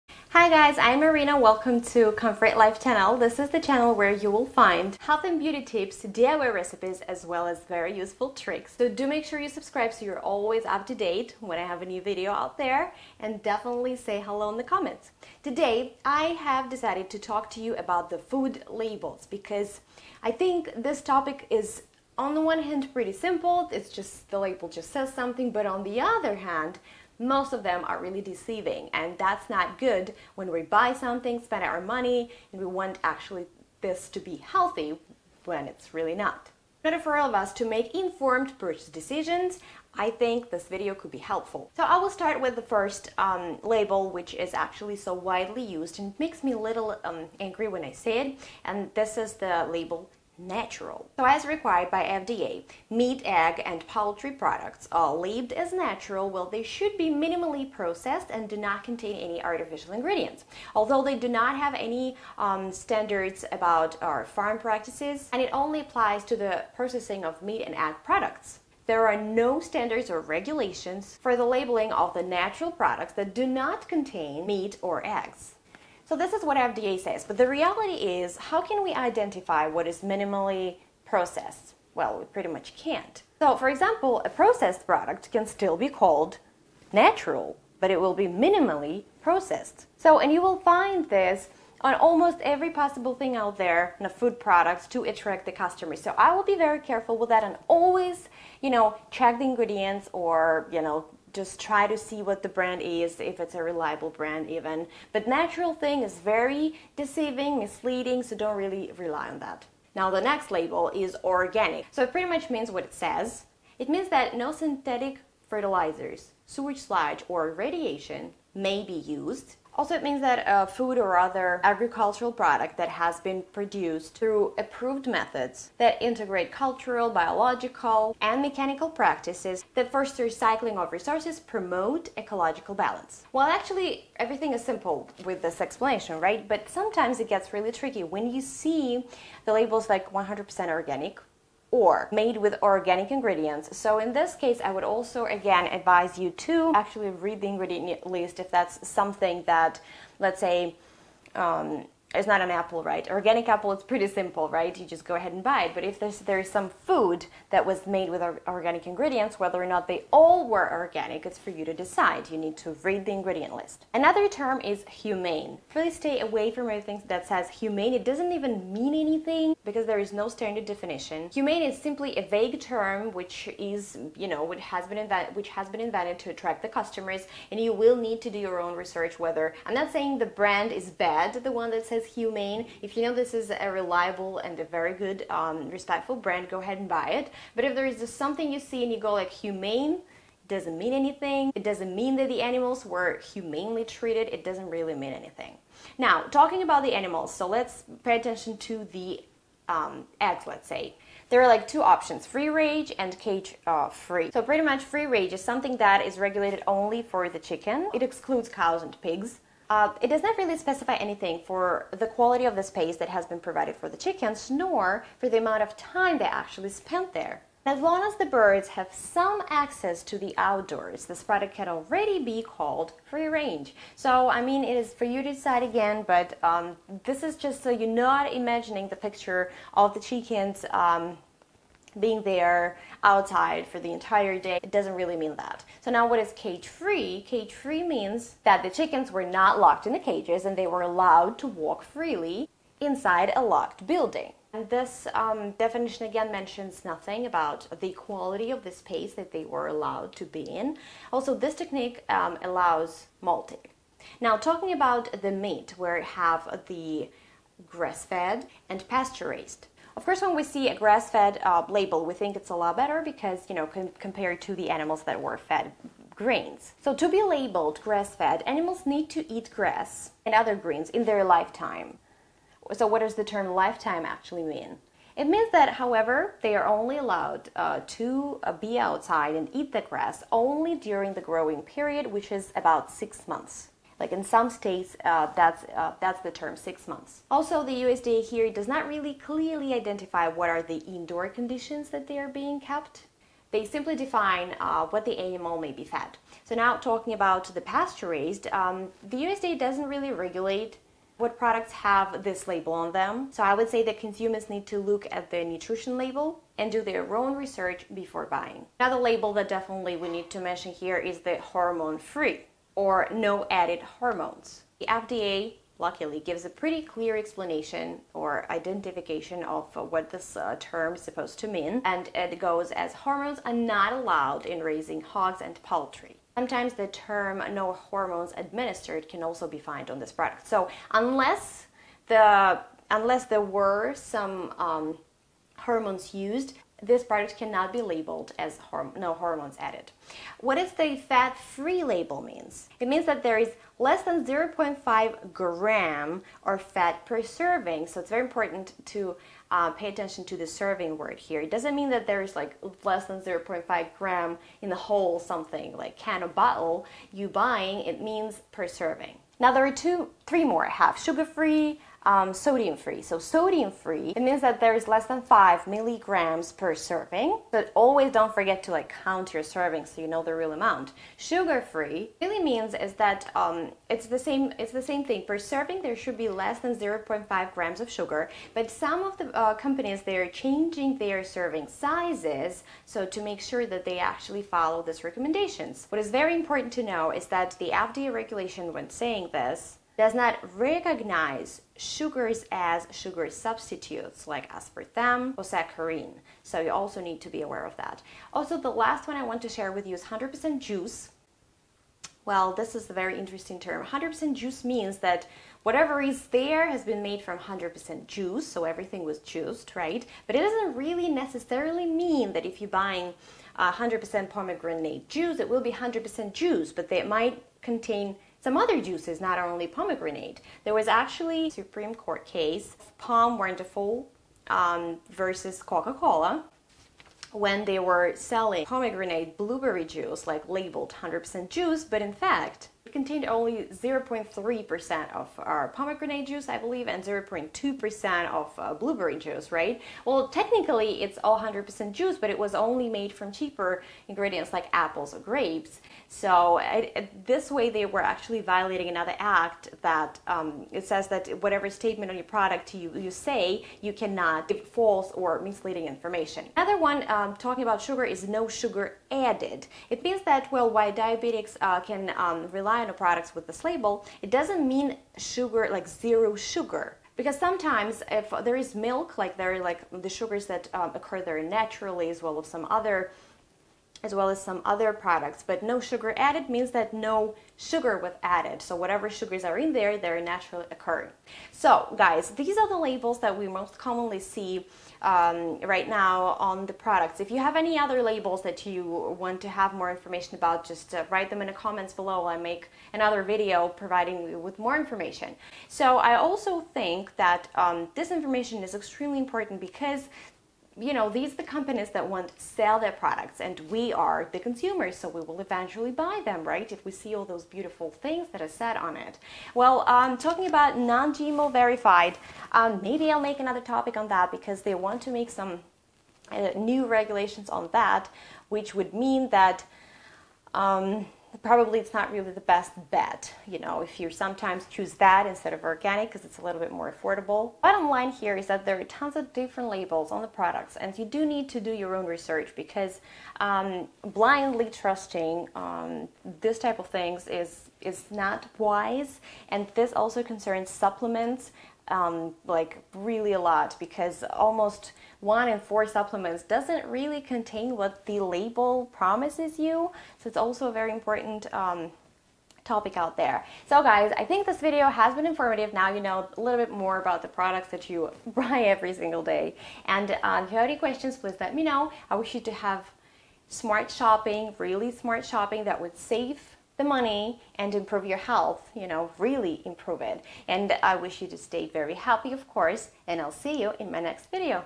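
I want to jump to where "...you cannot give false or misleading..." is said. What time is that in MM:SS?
07:33.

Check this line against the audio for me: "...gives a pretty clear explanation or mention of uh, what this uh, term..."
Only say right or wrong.
wrong.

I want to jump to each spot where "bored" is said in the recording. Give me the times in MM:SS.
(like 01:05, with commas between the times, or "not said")
not said.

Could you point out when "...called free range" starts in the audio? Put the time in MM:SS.
03:42.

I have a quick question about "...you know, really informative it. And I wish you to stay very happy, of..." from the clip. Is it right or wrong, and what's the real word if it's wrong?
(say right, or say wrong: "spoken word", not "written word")
wrong: "improve", not "informative".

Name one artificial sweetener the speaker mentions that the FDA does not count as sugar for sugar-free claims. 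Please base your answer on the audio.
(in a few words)
aspartame.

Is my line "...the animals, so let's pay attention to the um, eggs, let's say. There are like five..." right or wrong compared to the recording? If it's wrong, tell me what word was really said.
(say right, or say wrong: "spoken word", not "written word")
wrong: "two", not "five".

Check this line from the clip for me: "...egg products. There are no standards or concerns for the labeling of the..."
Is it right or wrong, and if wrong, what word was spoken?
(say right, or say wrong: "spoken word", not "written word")
wrong: "regulations", not "concerns".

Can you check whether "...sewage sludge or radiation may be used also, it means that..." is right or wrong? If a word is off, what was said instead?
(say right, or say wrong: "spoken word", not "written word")
right.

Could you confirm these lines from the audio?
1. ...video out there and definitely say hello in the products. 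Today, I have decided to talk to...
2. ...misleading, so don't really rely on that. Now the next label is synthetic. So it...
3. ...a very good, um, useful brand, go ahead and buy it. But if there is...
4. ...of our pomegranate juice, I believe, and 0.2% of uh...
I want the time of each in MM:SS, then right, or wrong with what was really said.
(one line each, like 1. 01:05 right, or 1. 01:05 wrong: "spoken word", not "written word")
1. 00:12 wrong: "comments", not "products"
2. 01:47 wrong: "organic", not "synthetic"
3. 03:04 wrong: "respectful", not "useful"
4. 07:15 right.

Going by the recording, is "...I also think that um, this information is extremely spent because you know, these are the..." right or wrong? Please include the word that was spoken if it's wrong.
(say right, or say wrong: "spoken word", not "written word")
wrong: "important", not "spent".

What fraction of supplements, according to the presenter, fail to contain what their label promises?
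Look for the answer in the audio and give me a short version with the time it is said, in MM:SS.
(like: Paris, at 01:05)
1 in 4, at 09:05.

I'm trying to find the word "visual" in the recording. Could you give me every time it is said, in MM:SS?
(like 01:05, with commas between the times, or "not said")
not said.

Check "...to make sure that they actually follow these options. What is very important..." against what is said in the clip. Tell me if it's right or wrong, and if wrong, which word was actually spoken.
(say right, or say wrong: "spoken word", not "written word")
wrong: "recommendations", not "options".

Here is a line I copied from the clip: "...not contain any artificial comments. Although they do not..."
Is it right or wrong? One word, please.
wrong.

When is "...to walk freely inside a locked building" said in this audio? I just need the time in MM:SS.
04:01.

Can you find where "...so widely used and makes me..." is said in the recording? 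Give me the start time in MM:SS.
00:44.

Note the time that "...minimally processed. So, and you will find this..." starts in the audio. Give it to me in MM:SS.
01:28.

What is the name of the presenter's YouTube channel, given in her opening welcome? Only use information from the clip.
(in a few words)
Comfort Life.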